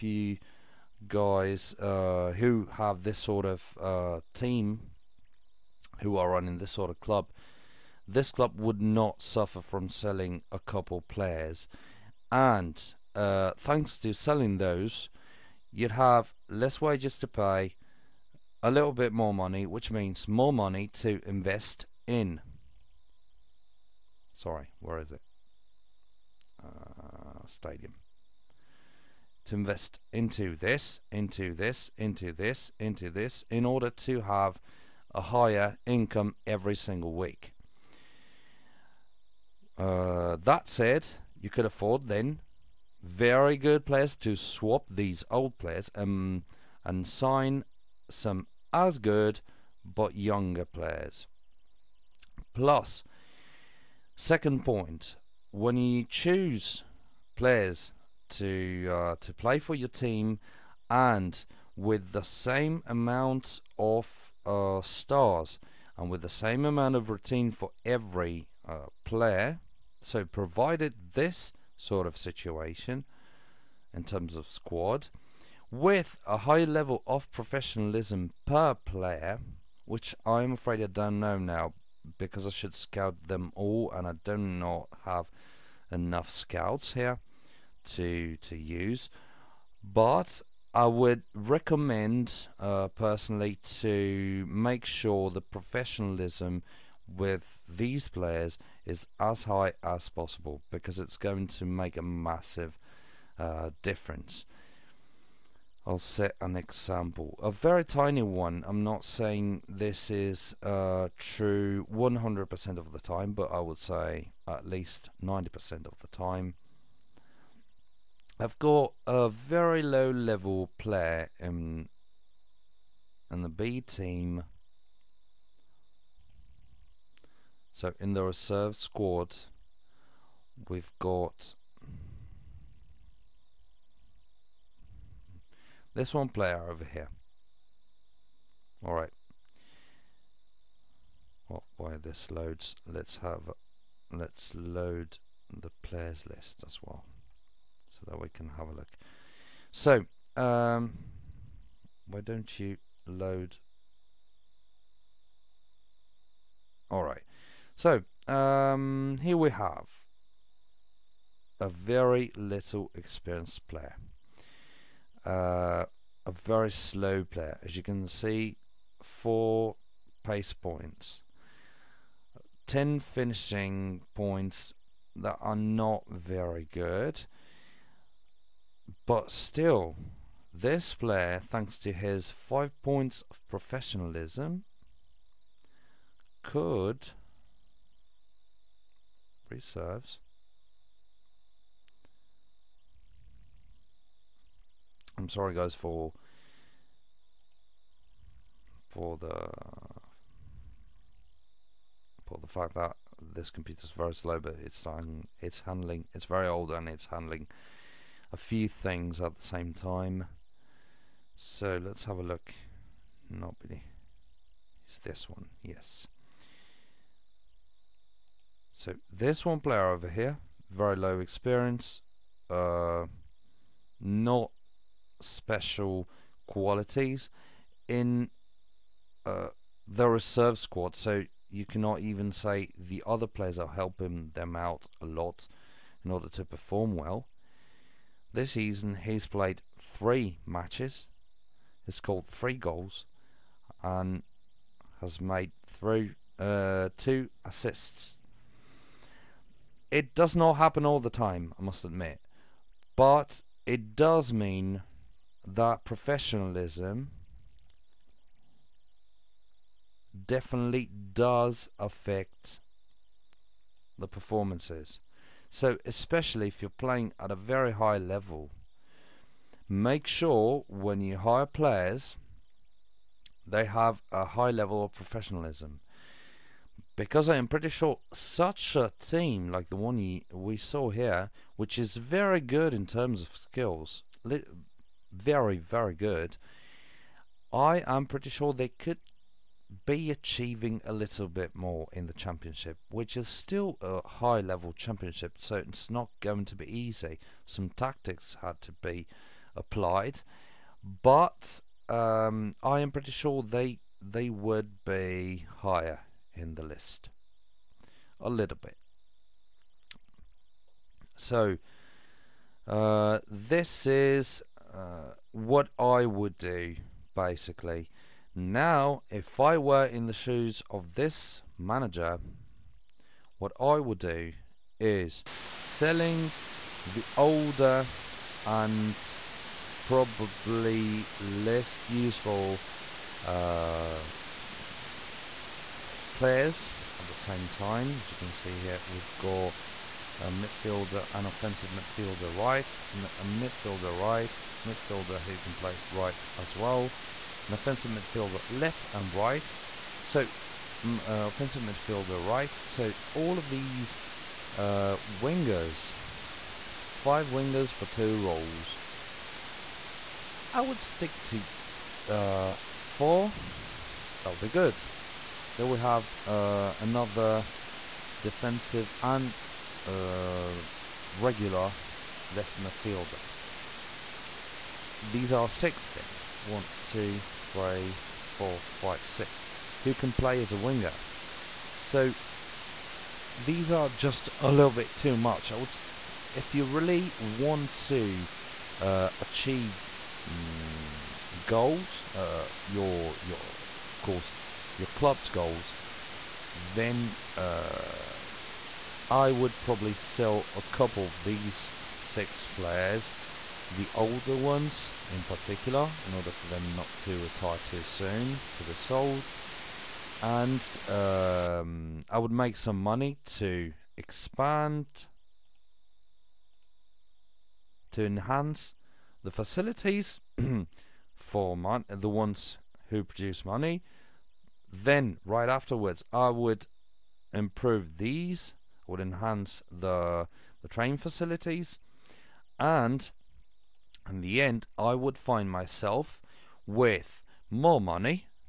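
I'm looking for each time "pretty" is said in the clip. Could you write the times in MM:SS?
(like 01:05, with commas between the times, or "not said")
04:37, 04:48, 05:02.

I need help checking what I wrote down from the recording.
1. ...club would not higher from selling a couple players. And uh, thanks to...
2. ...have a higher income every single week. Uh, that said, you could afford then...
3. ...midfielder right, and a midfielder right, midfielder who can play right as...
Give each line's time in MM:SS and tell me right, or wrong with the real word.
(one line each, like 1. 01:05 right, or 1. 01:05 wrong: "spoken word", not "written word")
1. 00:08 wrong: "suffer", not "higher"
2. 00:34 right
3. 05:41 right.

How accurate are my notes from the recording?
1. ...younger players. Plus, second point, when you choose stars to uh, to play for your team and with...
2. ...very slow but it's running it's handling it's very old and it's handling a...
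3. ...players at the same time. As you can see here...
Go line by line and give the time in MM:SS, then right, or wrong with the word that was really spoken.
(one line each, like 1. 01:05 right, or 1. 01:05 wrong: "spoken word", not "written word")
1. 00:50 wrong: "players", not "stars"
2. 03:23 wrong: "starting", not "running"
3. 05:36 right.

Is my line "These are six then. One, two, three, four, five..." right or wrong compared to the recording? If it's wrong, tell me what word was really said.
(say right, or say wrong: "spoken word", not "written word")
right.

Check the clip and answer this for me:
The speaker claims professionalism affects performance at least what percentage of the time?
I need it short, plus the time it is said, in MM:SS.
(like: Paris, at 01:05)
90%, at 01:55.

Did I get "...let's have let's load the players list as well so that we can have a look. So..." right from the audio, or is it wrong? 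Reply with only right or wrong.
right.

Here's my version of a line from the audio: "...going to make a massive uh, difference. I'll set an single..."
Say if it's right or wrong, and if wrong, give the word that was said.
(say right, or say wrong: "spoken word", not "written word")
wrong: "example", not "single".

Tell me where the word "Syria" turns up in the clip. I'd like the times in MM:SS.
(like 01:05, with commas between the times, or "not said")
not said.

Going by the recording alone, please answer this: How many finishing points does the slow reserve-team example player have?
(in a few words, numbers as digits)
10.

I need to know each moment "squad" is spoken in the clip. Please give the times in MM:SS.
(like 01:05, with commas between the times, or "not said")
01:14, 02:08, 03:50.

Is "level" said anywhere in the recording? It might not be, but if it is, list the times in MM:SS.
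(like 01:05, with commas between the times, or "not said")
01:16, 02:00, 04:27, 04:34, 04:54.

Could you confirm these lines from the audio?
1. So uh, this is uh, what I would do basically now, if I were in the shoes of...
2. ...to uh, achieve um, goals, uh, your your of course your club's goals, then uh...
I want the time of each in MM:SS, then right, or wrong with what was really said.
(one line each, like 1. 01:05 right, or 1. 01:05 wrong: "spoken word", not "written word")
1. 05:11 right
2. 06:27 right.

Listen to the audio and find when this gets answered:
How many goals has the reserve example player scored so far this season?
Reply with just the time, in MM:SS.
04:02.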